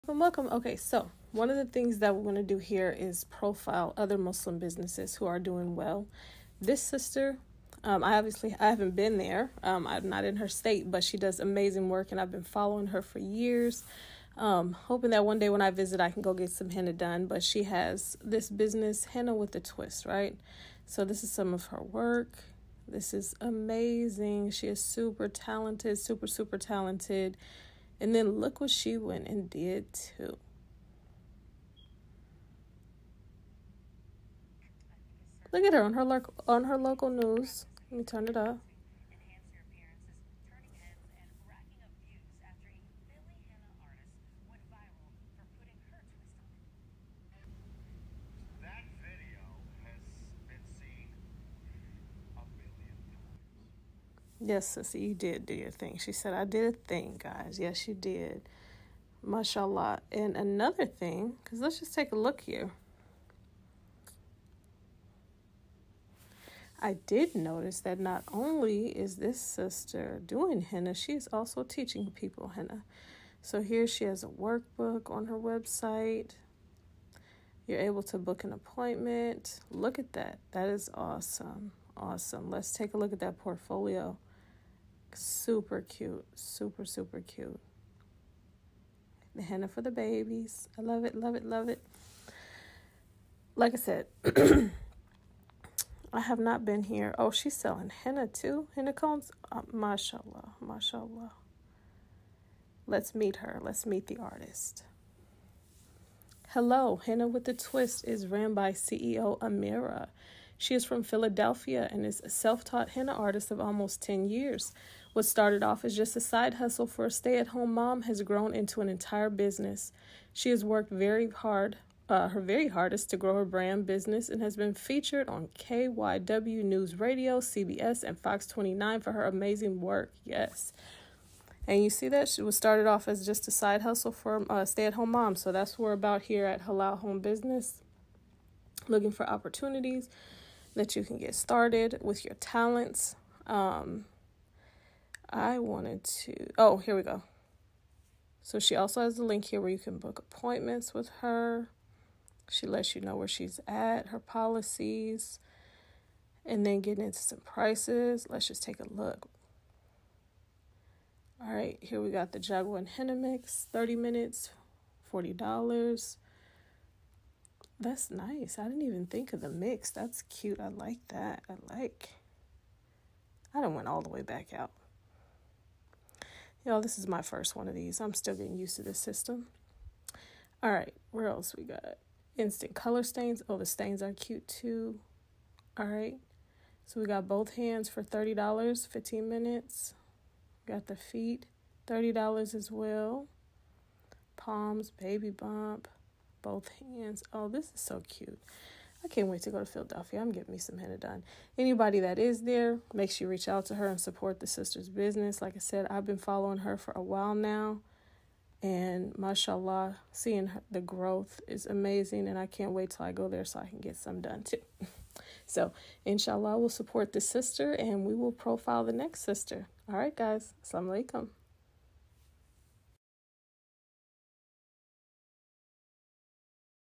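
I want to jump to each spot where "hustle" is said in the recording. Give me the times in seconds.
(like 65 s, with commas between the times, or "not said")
116 s, 133 s.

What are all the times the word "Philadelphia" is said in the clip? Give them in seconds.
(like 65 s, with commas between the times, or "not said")
111 s, 199 s.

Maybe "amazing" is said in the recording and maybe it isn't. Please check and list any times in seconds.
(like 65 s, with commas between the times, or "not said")
11 s, 23 s, 129 s, 211 s.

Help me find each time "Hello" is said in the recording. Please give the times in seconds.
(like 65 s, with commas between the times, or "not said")
106 s.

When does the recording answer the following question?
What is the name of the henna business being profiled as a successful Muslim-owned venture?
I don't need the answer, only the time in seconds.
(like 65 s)
19 s.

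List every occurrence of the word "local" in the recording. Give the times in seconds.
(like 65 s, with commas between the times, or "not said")
36 s.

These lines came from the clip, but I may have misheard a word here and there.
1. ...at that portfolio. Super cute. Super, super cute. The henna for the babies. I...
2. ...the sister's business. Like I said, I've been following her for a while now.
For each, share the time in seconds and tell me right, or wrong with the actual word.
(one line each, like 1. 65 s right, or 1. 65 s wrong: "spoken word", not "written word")
1. 83 s right
2. 204 s right.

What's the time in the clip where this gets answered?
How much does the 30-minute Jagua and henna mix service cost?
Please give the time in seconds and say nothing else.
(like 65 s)
165 s.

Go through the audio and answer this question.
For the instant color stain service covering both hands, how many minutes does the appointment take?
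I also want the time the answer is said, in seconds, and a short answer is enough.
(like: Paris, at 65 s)
15 minutes, at 188 s.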